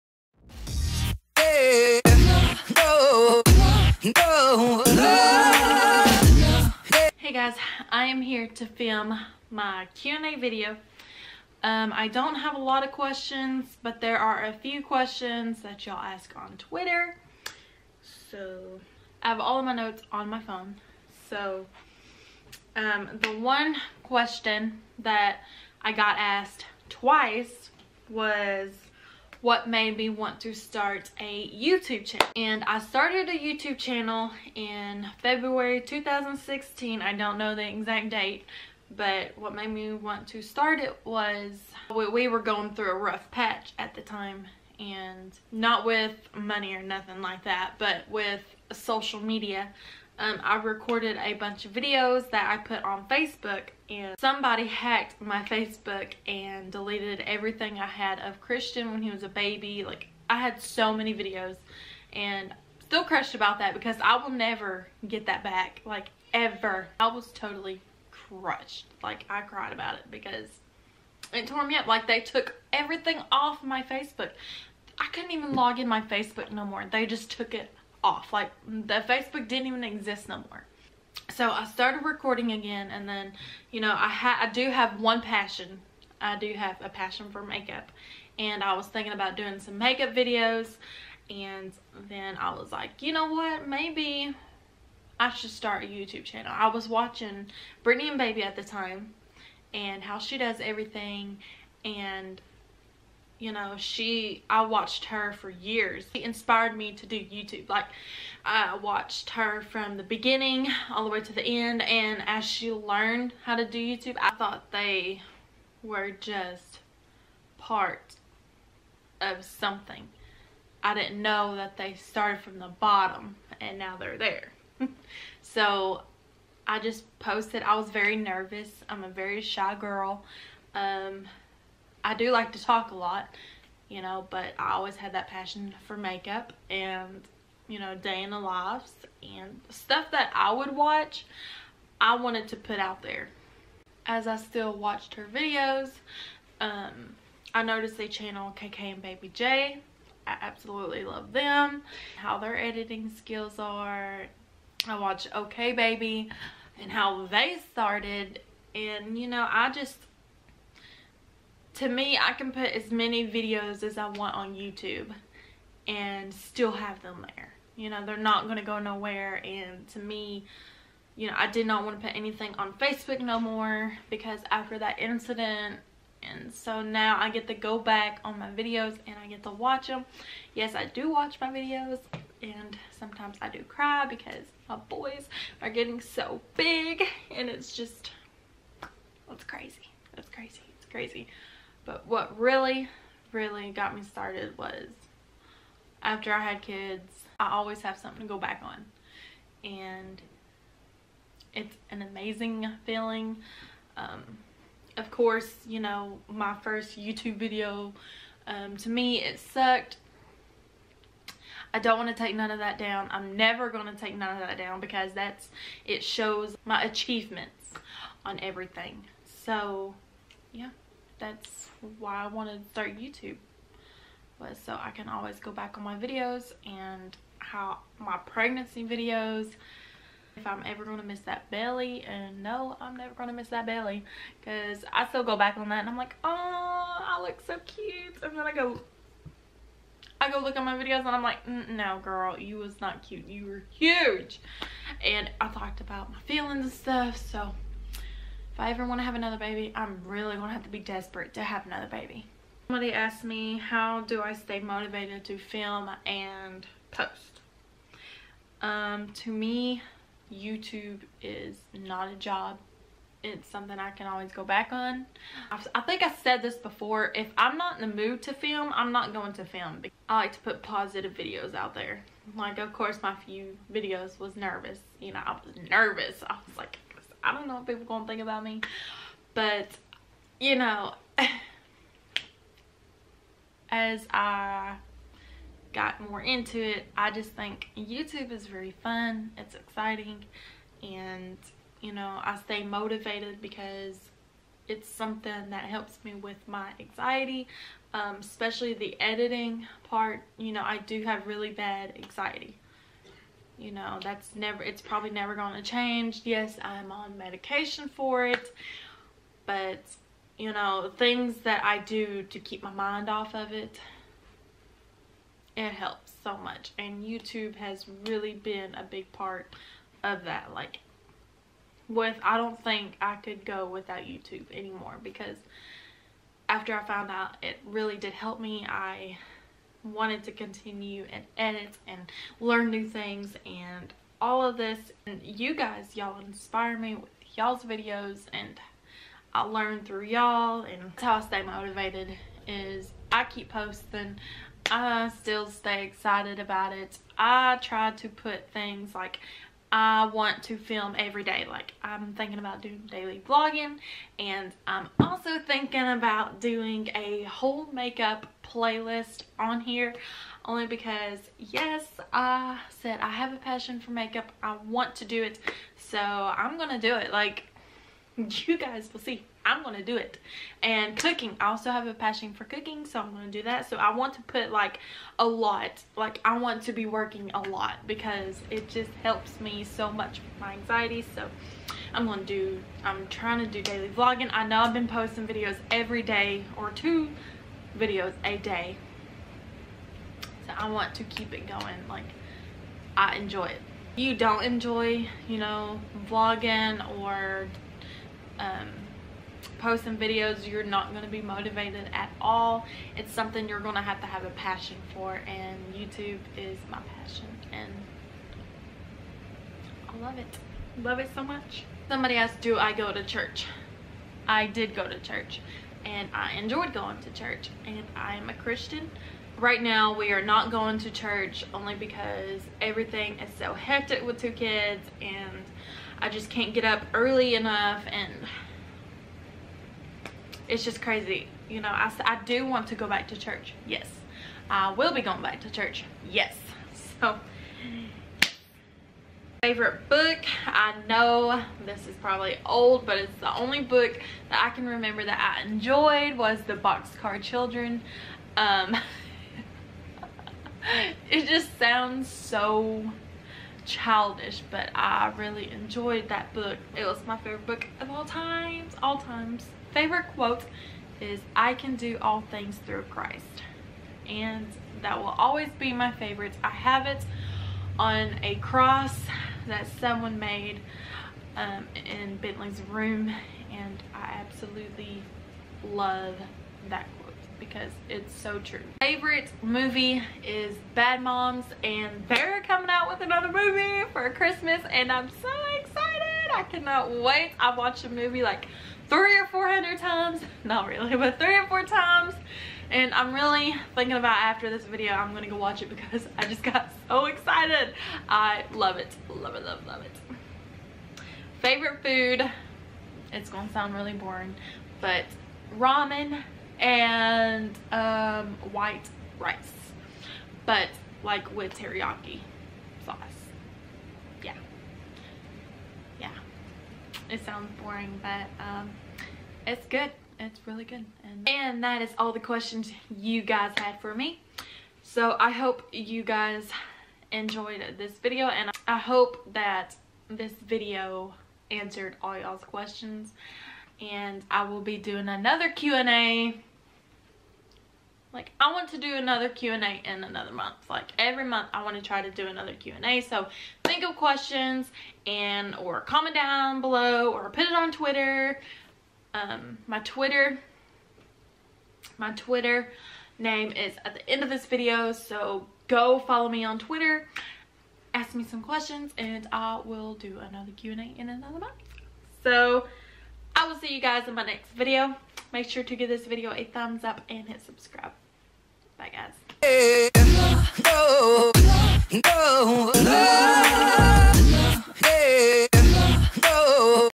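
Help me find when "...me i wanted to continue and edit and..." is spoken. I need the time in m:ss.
5:28.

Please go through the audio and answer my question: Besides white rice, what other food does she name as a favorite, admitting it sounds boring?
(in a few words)
Ramen.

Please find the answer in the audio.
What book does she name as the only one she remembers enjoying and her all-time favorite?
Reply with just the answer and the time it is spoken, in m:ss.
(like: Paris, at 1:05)
The Boxcar Children, at 7:26.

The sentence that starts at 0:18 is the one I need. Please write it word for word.
So, I have all of my notes on my phone.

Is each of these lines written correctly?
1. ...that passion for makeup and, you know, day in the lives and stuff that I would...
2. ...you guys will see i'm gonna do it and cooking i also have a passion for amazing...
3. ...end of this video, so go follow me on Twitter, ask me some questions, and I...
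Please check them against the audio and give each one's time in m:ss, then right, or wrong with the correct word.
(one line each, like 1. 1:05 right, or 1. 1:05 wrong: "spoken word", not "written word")
1. 2:15 right
2. 6:08 wrong: "cooking", not "amazing"
3. 9:14 right.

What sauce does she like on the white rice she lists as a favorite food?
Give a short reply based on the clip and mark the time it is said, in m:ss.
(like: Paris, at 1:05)
Teriyaki sauce, at 8:31.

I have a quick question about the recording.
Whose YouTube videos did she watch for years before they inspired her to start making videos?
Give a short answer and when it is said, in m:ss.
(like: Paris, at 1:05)
Brittany and Baby, at 1:37.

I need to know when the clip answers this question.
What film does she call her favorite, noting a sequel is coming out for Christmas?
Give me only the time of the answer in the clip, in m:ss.
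8:00.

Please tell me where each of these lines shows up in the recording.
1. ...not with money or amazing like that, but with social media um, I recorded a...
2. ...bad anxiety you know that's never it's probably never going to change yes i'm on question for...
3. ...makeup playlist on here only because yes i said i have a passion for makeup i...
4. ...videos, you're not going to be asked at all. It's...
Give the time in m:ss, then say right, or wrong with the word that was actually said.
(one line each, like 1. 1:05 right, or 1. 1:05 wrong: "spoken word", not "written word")
1. 0:45 wrong: "nothing", not "amazing"
2. 5:01 wrong: "medication", not "question"
3. 5:57 right
4. 6:39 wrong: "motivated", not "asked".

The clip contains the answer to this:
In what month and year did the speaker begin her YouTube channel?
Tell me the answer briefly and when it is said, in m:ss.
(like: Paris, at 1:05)
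February 2016, at 0:35.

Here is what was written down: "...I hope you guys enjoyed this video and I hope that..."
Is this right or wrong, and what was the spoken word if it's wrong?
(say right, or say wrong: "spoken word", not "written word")
right.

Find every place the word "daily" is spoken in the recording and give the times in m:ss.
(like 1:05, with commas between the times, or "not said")
5:52, 6:23.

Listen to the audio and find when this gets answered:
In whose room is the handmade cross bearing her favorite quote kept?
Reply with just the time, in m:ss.
7:52.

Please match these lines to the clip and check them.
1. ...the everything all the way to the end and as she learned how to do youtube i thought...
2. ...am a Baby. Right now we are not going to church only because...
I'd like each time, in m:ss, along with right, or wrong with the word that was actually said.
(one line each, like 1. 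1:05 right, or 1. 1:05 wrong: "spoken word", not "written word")
1. 1:49 wrong: "beginning", not "everything"
2. 6:58 wrong: "Christian", not "Baby".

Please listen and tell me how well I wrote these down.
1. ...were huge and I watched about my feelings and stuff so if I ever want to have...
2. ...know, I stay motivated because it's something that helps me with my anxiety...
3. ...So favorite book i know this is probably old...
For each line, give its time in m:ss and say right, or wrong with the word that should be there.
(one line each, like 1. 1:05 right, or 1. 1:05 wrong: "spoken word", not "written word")
1. 4:03 wrong: "talked", not "watched"
2. 4:51 right
3. 7:17 right.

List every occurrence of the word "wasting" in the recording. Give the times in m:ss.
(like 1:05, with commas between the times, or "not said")
not said.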